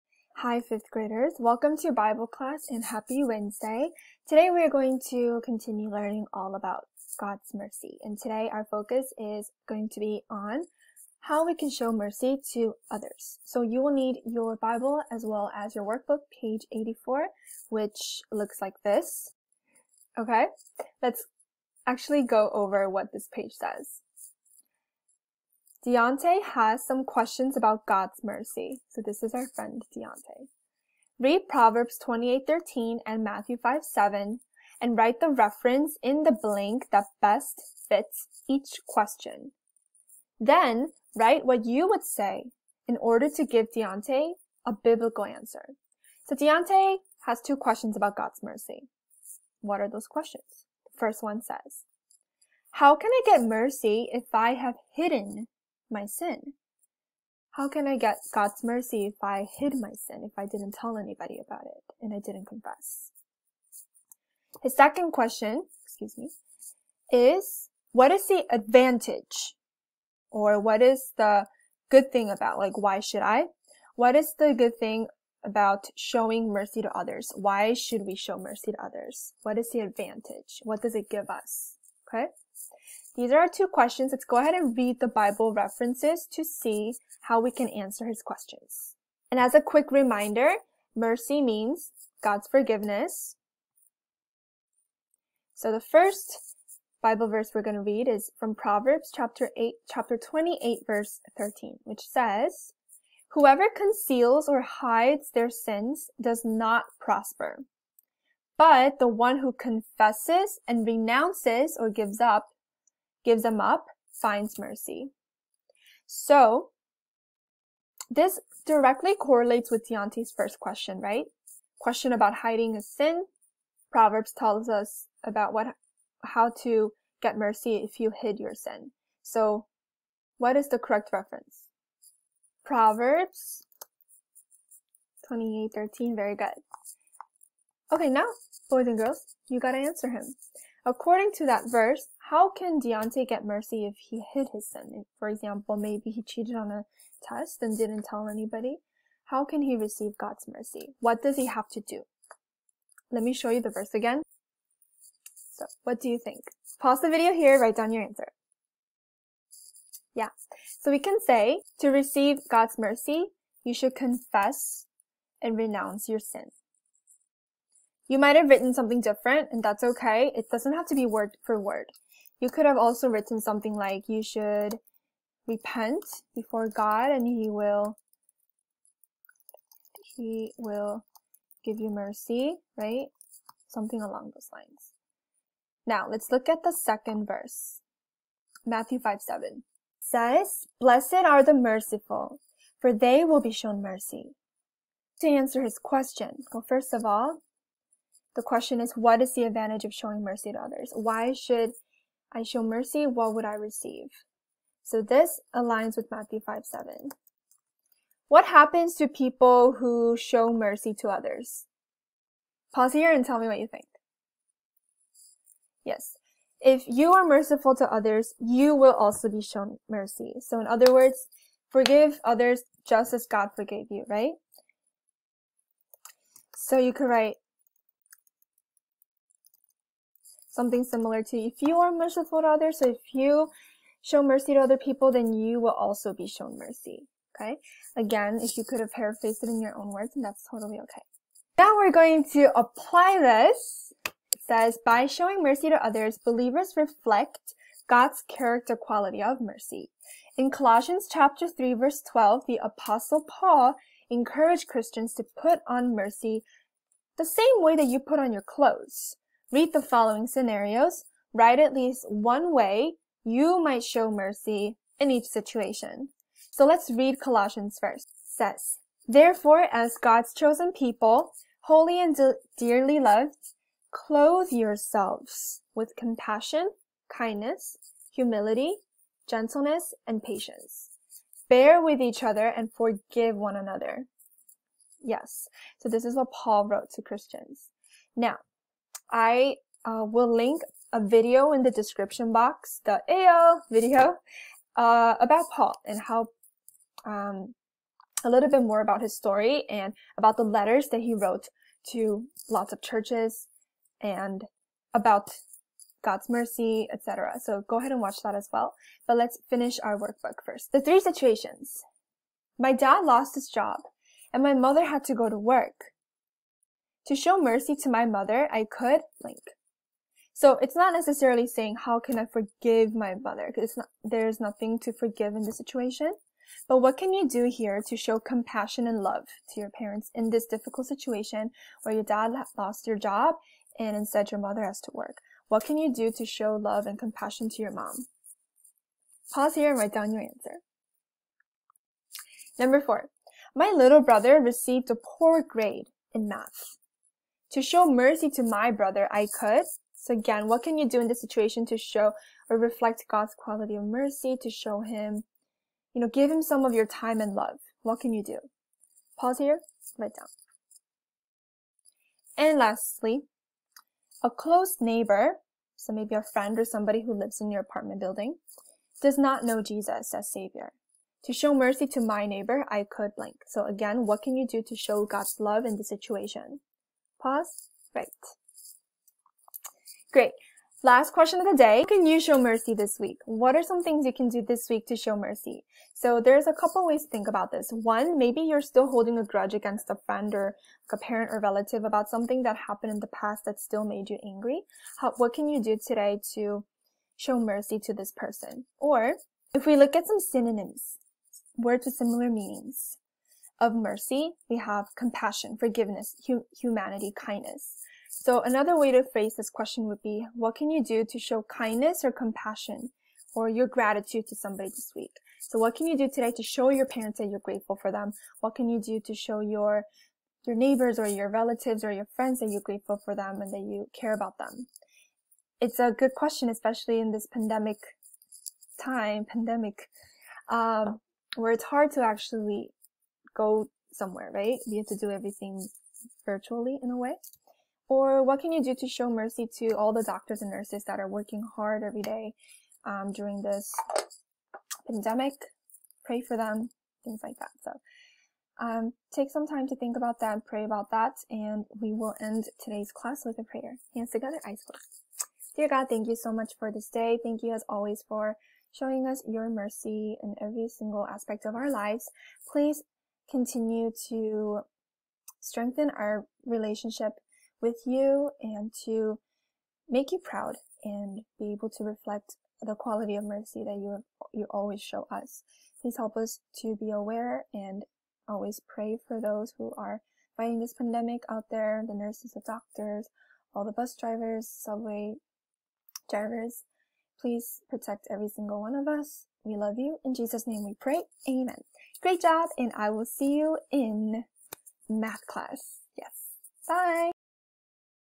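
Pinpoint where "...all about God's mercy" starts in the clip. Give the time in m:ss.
0:06.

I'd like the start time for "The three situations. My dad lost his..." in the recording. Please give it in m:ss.
5:10.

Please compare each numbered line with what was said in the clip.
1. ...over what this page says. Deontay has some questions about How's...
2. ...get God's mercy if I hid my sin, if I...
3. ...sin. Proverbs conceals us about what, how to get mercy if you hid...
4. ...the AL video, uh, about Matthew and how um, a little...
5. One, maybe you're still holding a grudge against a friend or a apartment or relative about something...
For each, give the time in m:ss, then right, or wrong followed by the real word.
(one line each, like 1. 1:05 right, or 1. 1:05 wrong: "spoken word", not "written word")
1. 0:22 wrong: "God", not "How"
2. 0:57 right
3. 2:02 wrong: "tells", not "conceals"
4. 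4:52 wrong: "Paul", not "Matthew"
5. 6:27 wrong: "parent", not "apartment".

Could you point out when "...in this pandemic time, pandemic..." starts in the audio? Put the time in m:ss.
7:06.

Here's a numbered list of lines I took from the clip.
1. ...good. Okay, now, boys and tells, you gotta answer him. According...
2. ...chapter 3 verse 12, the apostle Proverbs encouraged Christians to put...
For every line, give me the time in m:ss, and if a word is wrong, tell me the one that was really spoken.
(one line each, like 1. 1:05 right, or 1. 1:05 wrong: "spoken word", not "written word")
1. 2:16 wrong: "girls", not "tells"
2. 4:11 wrong: "Paul", not "Proverbs".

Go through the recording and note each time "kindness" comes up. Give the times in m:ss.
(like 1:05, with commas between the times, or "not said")
4:37, 6:47, 6:51.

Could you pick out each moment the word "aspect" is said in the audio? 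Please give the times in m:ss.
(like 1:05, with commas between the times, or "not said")
7:41.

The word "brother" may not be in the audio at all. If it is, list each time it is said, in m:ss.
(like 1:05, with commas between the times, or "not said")
5:44, 5:48.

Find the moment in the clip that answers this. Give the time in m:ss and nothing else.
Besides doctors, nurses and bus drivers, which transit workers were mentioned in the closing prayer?
8:04.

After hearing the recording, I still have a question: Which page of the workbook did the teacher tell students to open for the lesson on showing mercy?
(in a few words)
84.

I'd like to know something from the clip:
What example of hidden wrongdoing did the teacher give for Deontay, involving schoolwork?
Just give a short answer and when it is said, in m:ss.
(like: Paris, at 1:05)
cheated on a test, at 2:26.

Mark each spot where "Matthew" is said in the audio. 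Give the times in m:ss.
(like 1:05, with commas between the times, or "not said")
0:33, 3:08, 3:26.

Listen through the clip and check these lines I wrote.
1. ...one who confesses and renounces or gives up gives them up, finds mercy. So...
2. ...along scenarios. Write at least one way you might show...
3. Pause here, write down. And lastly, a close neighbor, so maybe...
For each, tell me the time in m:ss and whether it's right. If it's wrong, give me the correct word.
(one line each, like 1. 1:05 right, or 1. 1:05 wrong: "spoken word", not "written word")
1. 1:49 right
2. 4:19 wrong: "following", not "along"
3. 5:59 right.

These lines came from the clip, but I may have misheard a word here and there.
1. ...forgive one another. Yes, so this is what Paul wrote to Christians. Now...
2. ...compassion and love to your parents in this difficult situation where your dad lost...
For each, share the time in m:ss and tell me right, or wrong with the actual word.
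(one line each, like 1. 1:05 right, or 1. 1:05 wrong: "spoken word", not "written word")
1. 4:42 right
2. 5:28 right.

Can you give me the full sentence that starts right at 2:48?
You might have written something different, and that's okay.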